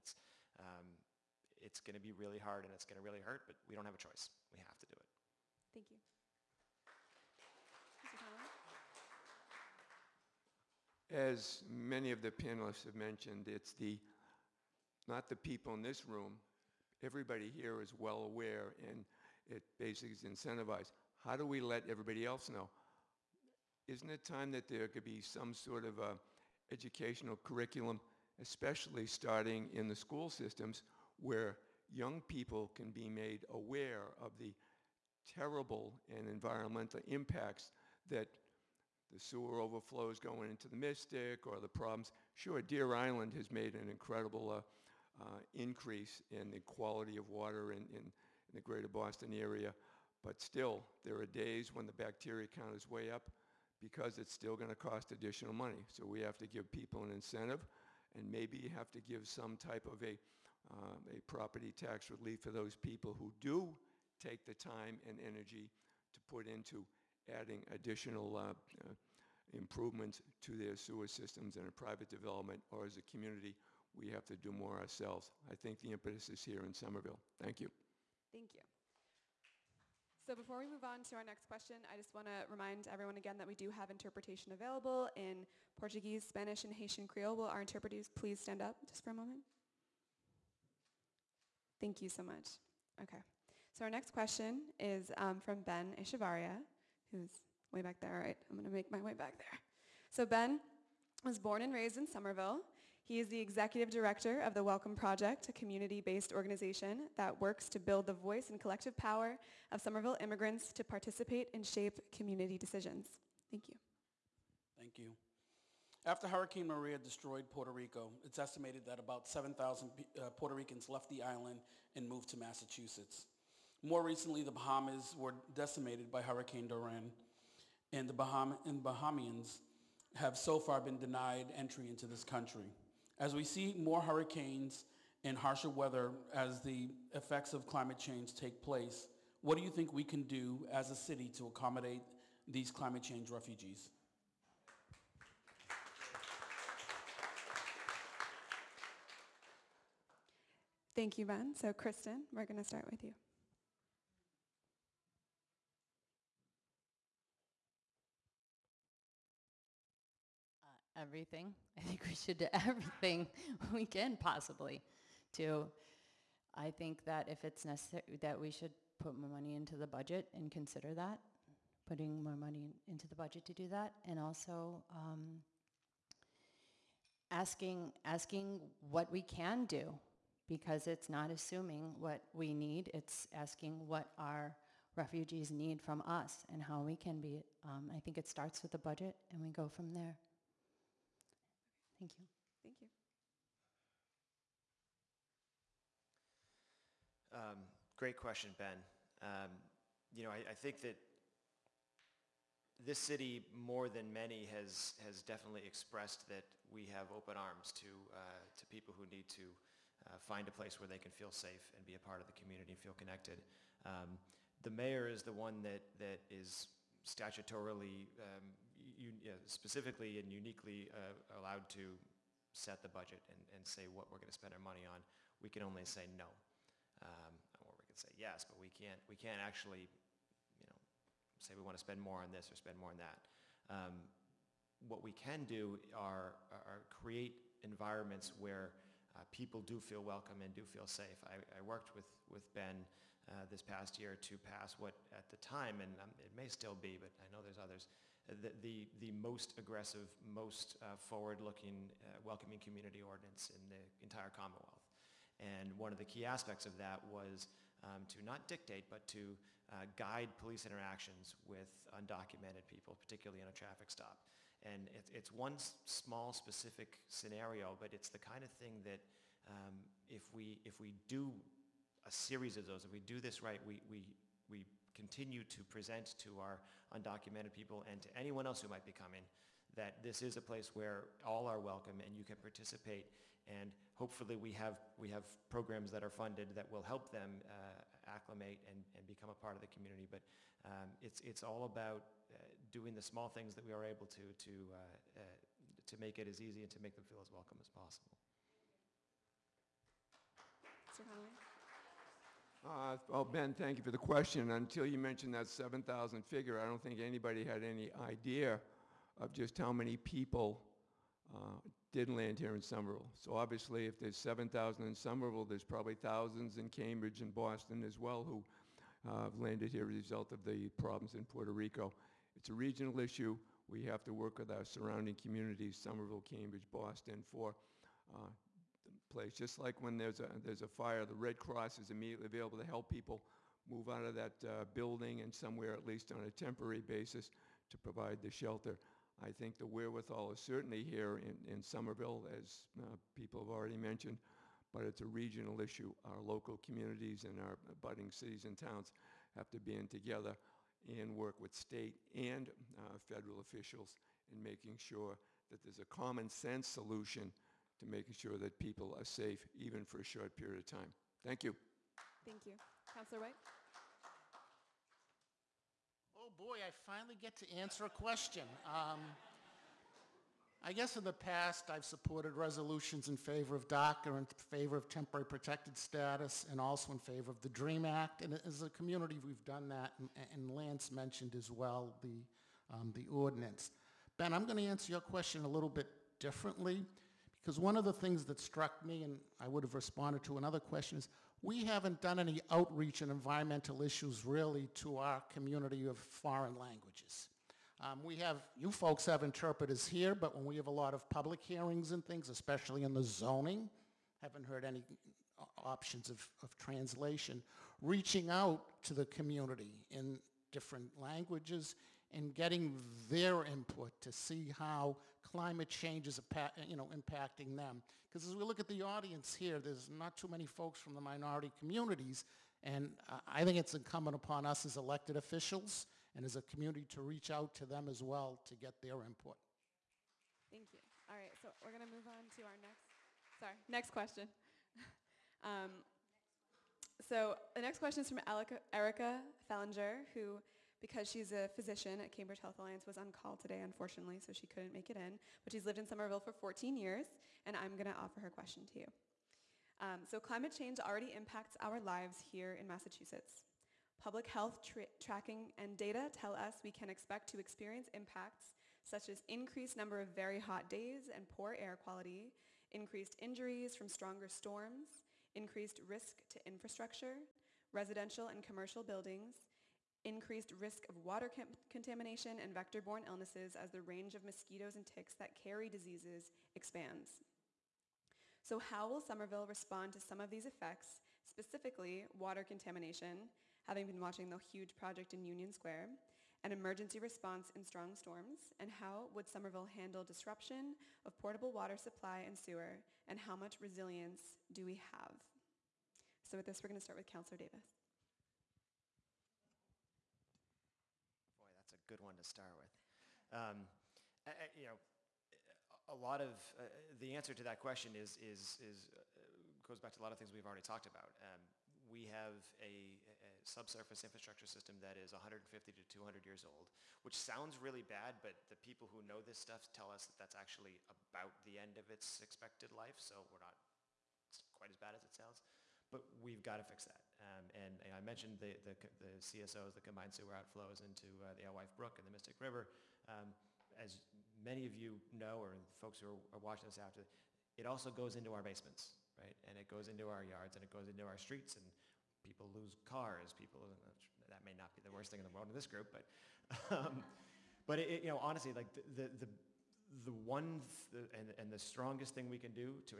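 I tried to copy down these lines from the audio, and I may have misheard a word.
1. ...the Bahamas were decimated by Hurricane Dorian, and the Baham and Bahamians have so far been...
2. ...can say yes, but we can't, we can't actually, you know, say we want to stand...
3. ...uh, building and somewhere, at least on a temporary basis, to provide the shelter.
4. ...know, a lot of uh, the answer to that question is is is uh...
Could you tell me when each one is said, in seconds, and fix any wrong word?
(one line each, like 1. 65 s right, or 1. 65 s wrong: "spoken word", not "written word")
1. 124 s right
2. 227 s wrong: "spend", not "stand"
3. 334 s right
4. 504 s right.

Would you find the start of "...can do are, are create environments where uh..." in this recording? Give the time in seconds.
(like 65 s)
235 s.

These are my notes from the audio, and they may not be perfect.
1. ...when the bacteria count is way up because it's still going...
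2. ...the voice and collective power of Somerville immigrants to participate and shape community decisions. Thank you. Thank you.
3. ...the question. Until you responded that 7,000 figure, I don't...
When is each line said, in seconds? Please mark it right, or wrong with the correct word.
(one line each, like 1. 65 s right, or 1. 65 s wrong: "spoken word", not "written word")
1. 51 s right
2. 108 s right
3. 303 s wrong: "mentioned", not "responded".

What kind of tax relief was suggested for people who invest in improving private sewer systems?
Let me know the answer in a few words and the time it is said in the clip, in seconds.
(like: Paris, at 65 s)
property tax relief, at 61 s.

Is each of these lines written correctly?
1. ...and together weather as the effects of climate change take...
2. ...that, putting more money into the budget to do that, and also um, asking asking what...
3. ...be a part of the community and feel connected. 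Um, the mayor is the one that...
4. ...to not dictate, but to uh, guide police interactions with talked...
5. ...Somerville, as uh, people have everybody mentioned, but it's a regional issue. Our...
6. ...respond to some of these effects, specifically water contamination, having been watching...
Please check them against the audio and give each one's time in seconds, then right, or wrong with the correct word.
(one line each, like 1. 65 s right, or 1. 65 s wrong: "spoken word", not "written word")
1. 135 s wrong: "harsher", not "together"
2. 170 s right
3. 211 s right
4. 258 s wrong: "undocumented", not "talked"
5. 341 s wrong: "already", not "everybody"
6. 479 s right.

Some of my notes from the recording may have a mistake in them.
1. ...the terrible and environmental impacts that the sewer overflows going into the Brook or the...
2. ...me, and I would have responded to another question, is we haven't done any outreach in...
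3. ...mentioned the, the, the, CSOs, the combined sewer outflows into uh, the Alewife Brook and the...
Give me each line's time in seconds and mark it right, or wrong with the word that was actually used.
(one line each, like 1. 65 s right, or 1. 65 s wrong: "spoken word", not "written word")
1. 34 s wrong: "Mystic", not "Brook"
2. 388 s right
3. 528 s right.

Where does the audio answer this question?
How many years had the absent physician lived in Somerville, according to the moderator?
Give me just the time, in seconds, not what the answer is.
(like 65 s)
446 s.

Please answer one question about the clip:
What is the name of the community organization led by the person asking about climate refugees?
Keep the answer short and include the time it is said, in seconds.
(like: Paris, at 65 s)
the Welcome Project, at 104 s.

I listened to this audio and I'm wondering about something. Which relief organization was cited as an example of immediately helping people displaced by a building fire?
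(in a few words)
the Red Cross.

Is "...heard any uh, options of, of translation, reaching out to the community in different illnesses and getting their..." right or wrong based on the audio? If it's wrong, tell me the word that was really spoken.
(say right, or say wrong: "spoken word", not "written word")
wrong: "languages", not "illnesses".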